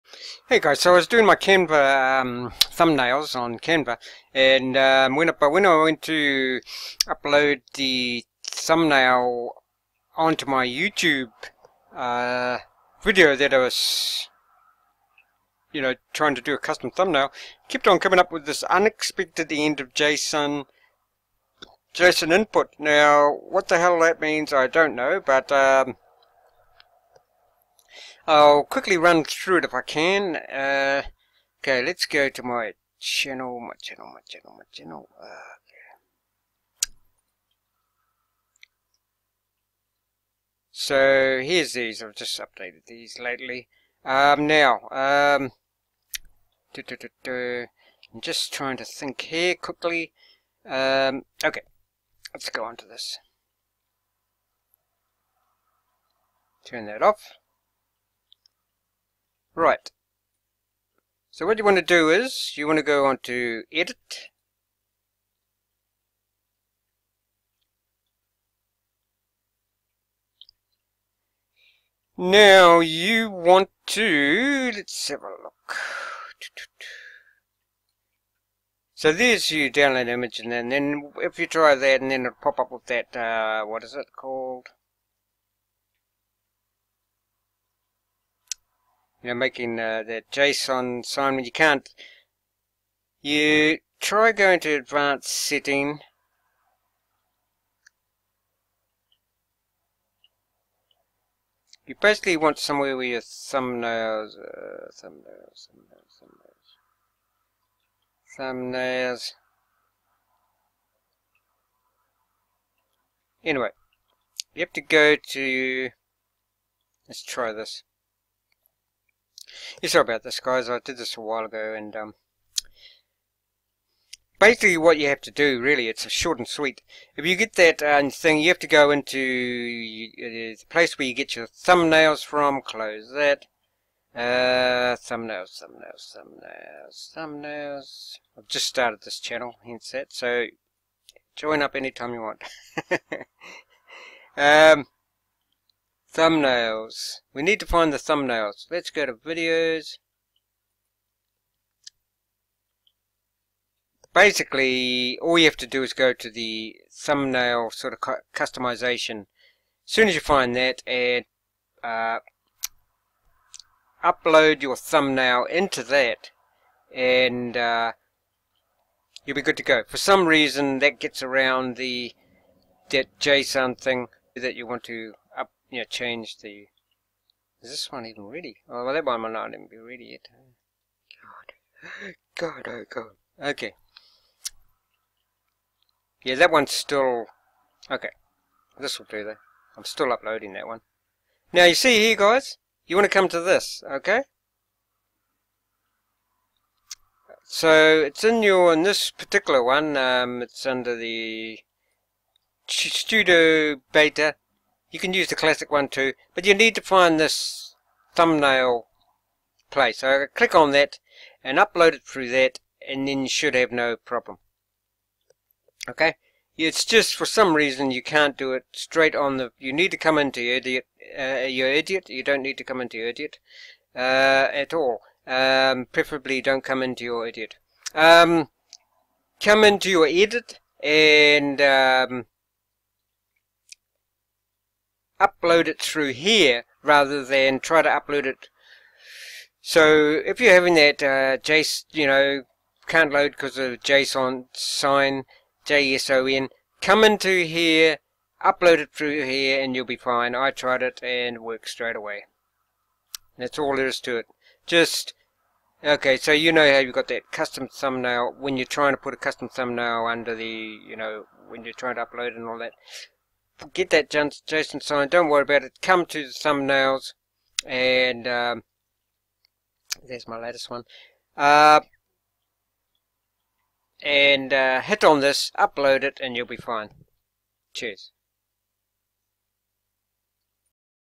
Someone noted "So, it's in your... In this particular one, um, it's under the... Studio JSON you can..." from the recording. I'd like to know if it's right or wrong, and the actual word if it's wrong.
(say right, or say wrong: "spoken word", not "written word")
wrong: "Beta", not "JSON".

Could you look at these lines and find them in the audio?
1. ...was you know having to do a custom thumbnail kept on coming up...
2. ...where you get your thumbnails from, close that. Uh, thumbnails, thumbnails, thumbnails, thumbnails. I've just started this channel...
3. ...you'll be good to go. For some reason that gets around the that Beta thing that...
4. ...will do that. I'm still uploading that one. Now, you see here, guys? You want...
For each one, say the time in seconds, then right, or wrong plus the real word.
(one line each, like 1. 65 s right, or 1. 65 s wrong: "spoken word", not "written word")
1. 13 s wrong: "trying", not "having"
2. 130 s right
3. 169 s wrong: "JSON", not "Beta"
4. 188 s right.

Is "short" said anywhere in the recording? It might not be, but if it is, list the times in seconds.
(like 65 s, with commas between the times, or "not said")
126 s.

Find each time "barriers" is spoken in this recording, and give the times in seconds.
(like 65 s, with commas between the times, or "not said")
not said.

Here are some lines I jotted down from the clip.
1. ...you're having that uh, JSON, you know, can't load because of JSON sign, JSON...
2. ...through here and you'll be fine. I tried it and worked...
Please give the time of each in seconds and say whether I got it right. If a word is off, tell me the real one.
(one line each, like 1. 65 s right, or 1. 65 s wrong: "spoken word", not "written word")
1. 240 s right
2. 248 s right.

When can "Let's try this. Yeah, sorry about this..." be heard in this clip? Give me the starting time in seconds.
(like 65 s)
117 s.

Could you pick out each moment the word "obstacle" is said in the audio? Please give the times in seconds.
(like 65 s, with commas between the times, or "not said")
not said.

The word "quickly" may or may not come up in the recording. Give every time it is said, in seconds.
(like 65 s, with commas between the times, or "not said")
28 s, 49 s.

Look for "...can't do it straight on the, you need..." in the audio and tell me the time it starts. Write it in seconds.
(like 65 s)
218 s.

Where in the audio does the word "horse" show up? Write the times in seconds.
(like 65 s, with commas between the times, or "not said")
not said.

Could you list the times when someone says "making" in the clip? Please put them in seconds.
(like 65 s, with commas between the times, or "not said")
89 s.